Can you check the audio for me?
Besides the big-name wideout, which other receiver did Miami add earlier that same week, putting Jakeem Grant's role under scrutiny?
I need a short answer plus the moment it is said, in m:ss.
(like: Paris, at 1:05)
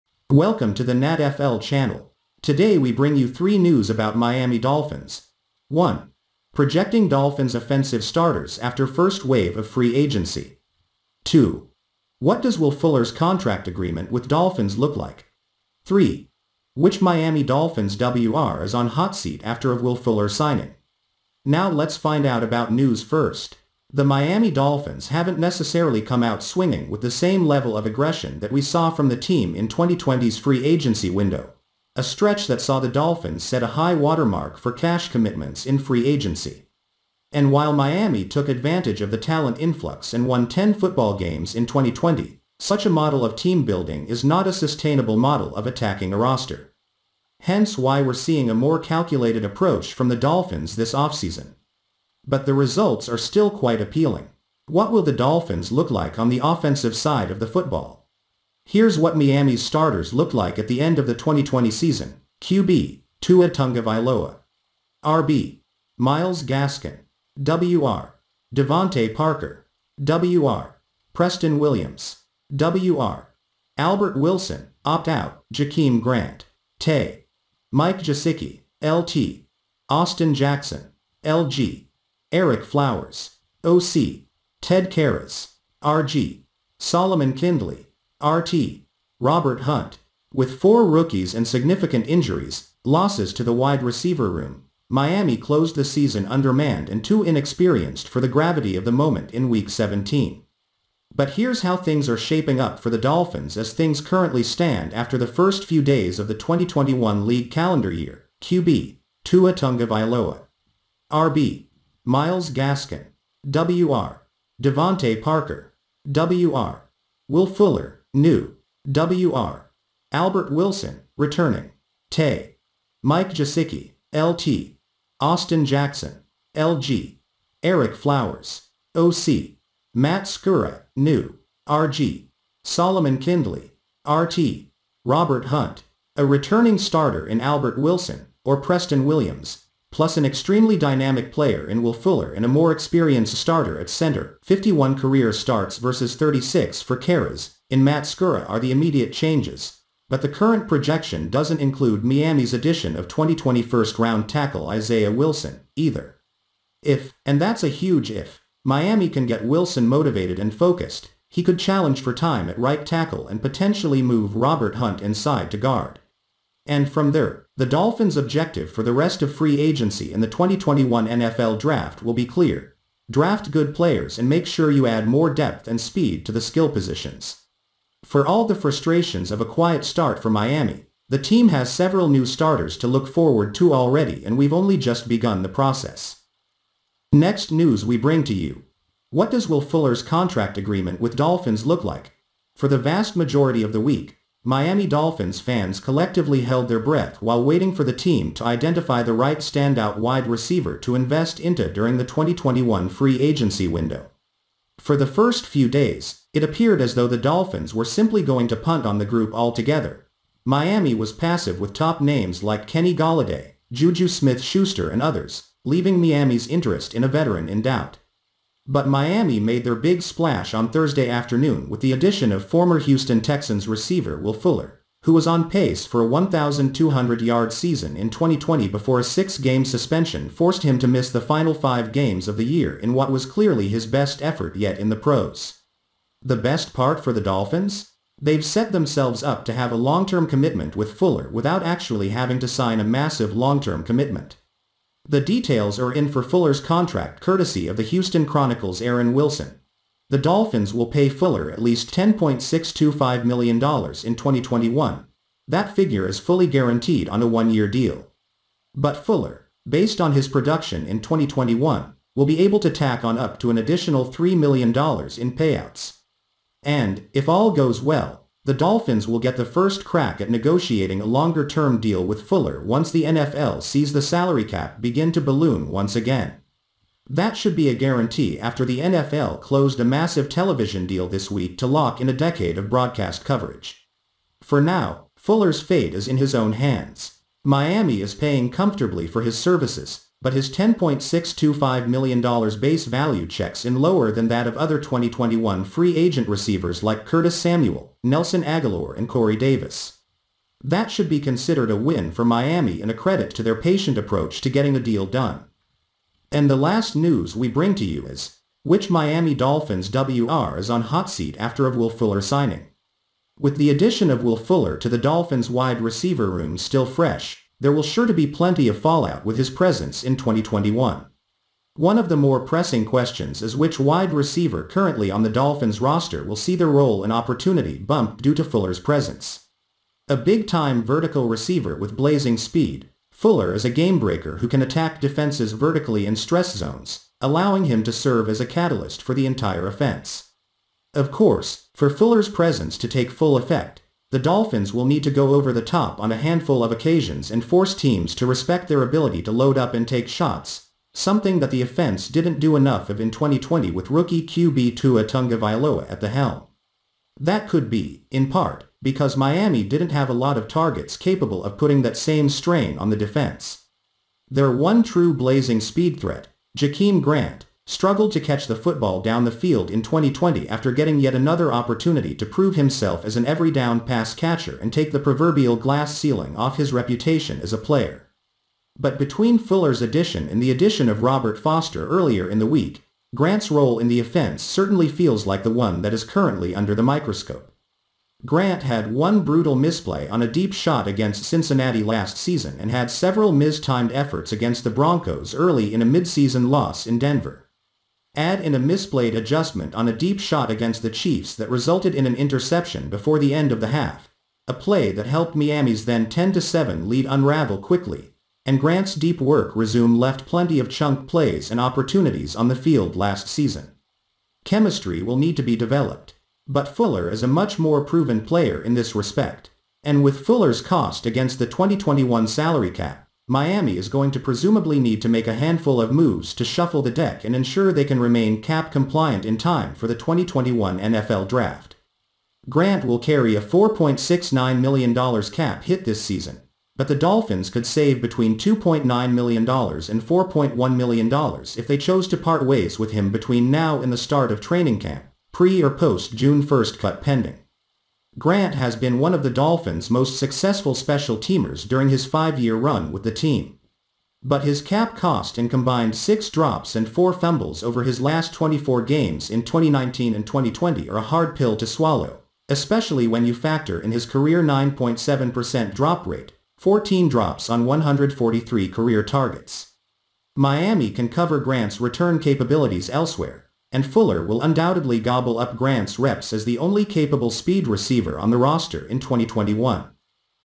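Robert Foster, at 6:21.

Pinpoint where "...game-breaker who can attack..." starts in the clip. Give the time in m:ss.
5:33.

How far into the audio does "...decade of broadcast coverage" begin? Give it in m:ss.
4:42.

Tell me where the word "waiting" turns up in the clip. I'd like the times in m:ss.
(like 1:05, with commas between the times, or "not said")
3:17.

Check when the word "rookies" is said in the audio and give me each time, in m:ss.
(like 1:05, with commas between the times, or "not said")
1:30, 5:53.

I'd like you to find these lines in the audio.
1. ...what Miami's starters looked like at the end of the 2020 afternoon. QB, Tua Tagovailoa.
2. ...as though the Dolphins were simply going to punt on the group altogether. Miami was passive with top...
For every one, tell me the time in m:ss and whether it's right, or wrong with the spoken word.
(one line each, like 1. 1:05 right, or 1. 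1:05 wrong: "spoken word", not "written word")
1. 0:58 wrong: "season", not "afternoon"
2. 3:26 right.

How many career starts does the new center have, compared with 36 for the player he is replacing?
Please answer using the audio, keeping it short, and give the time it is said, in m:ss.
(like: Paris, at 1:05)
51, at 2:24.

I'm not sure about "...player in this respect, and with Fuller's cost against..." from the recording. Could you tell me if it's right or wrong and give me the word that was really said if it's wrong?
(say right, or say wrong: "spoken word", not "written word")
right.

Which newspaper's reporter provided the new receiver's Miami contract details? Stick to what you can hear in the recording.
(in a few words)
Houston Chronicle.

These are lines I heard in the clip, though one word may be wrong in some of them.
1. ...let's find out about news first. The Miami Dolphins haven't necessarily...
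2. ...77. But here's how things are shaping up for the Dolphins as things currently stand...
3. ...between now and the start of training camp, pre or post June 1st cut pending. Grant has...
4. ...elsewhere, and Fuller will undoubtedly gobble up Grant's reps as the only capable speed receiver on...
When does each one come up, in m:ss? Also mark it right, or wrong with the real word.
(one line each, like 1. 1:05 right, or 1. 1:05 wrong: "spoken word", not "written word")
1. 0:21 right
2. 1:39 wrong: "17", not "77"
3. 7:23 right
4. 7:52 right.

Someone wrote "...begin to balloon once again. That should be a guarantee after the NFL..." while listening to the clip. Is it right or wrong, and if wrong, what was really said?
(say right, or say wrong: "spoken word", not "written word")
right.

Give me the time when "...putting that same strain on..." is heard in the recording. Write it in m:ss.
6:01.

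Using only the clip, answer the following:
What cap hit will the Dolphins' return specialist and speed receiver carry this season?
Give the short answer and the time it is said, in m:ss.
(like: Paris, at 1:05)
$4.69 million, at 7:13.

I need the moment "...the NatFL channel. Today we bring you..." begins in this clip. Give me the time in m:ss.
0:00.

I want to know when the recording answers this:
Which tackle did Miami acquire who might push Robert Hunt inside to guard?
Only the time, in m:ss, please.
2:34.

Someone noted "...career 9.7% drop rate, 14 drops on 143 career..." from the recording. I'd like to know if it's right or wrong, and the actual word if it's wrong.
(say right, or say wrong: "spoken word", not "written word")
right.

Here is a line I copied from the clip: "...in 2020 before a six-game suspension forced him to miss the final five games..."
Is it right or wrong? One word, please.
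right.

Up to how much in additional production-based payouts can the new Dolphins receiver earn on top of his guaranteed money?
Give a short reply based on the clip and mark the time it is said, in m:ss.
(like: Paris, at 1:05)
$3 million, at 4:24.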